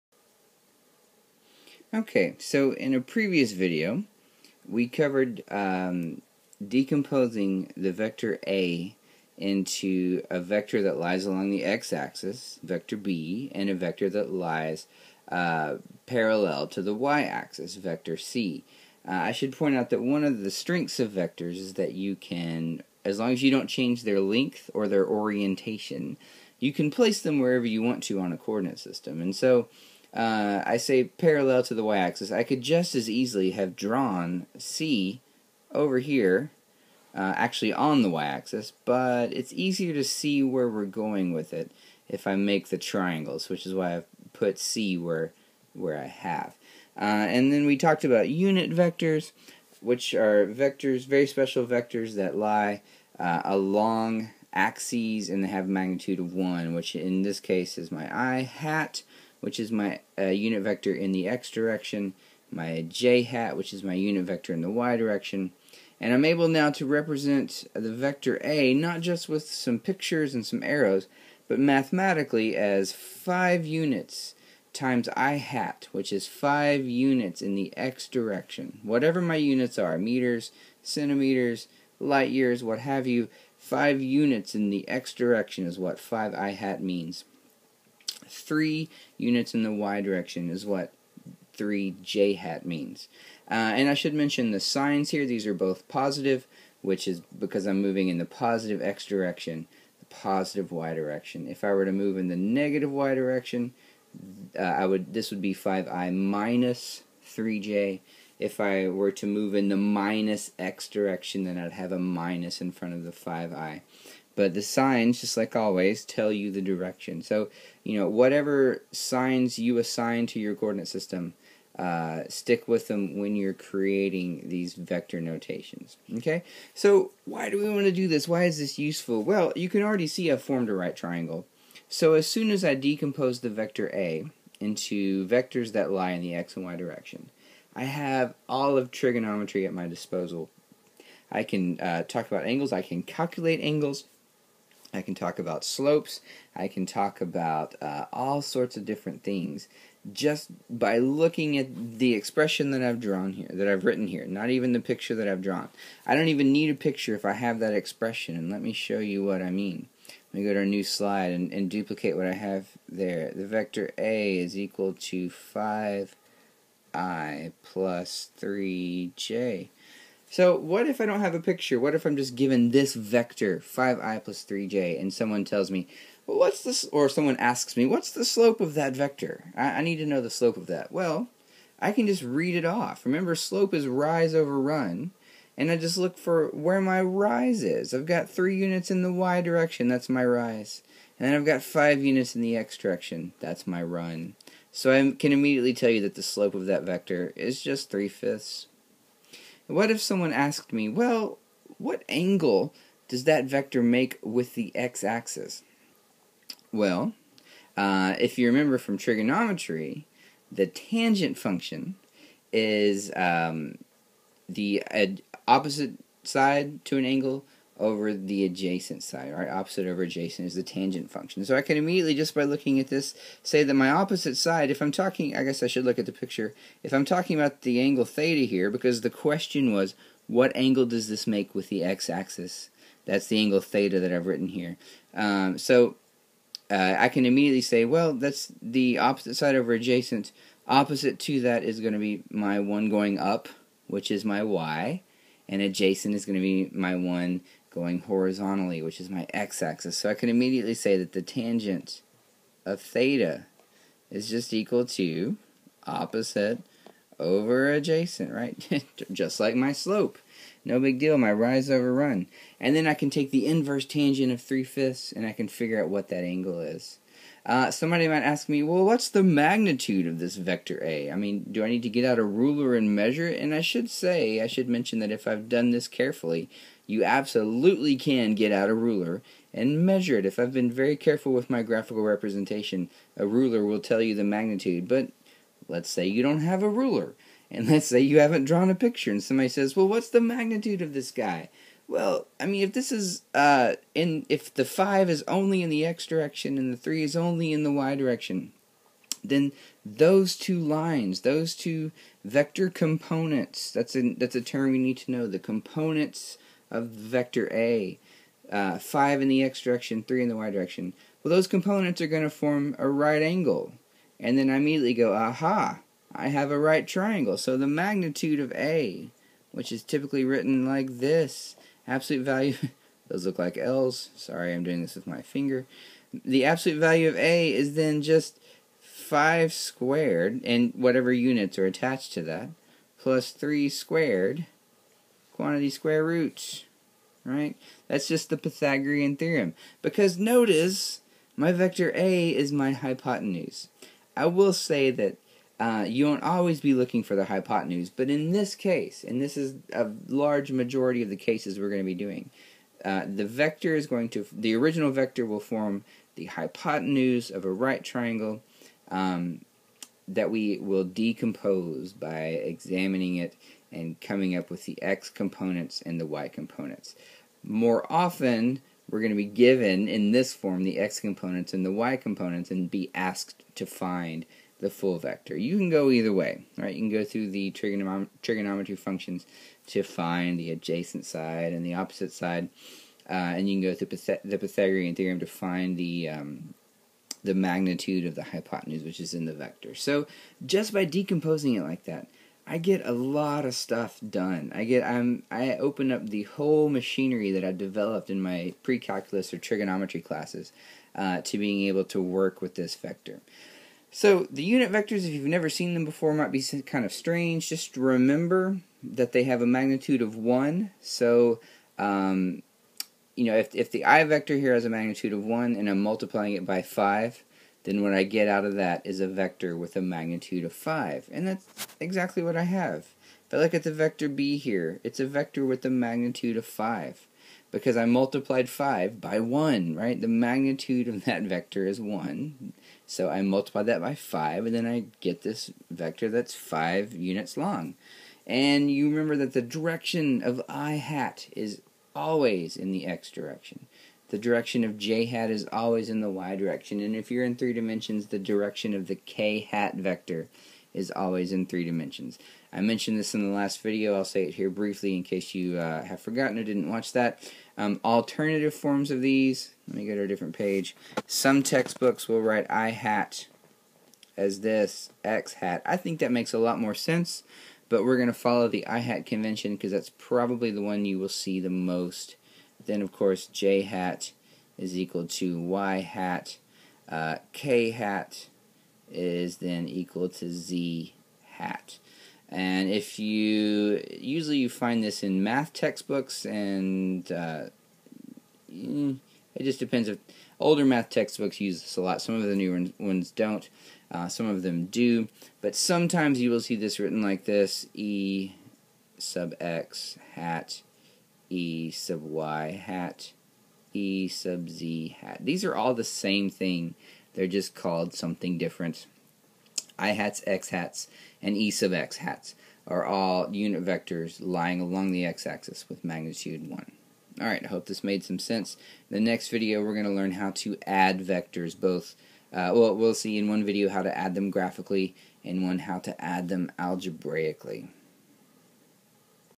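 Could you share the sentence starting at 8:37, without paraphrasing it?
Alright, I hope this made some sense.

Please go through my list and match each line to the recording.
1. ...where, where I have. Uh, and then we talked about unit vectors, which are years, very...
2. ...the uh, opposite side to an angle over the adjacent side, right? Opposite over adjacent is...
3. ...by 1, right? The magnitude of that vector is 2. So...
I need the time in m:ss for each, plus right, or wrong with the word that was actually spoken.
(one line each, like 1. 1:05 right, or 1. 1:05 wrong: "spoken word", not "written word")
1. 0:44 wrong: "vectors", not "years"
2. 3:34 right
3. 7:08 wrong: "1", not "2".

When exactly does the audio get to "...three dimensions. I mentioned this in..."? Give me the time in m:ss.
7:31.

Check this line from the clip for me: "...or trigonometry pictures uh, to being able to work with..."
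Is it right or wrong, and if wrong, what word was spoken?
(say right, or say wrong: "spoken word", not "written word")
wrong: "classes", not "pictures".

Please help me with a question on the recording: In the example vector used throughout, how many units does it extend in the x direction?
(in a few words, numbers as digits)
5.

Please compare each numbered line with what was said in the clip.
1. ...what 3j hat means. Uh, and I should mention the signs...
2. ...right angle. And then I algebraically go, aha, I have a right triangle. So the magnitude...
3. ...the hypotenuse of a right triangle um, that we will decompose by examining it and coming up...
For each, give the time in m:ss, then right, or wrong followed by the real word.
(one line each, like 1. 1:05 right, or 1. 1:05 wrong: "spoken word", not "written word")
1. 1:30 right
2. 5:12 wrong: "immediately", not "algebraically"
3. 5:56 right.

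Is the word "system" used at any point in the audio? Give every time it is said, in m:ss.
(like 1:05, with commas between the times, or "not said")
0:28, 2:00.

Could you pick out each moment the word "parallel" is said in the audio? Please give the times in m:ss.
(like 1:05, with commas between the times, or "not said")
0:16, 0:31.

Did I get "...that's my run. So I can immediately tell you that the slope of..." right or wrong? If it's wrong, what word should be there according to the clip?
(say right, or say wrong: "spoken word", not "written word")
right.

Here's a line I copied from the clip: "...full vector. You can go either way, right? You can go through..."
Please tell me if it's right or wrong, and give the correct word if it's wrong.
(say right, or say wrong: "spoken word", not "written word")
right.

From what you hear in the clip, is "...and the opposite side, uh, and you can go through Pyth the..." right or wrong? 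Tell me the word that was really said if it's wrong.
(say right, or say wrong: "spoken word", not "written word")
right.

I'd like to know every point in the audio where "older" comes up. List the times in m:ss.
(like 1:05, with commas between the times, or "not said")
8:10.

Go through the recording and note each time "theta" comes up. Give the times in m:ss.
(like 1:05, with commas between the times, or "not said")
3:48, 3:53, 4:12.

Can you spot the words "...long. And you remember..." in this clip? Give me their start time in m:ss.
7:17.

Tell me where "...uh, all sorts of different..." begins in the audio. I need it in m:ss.
2:27.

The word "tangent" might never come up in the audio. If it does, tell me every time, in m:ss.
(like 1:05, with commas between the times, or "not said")
3:30, 3:40, 4:11, 4:23.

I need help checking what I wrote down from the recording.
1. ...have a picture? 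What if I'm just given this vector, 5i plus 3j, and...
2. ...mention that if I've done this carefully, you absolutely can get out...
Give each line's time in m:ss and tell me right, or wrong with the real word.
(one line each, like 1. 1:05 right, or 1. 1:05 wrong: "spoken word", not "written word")
1. 2:51 right
2. 4:34 right.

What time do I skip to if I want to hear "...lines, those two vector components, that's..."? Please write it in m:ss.
5:00.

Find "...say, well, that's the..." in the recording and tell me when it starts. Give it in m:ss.
3:57.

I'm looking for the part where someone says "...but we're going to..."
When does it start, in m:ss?
7:47.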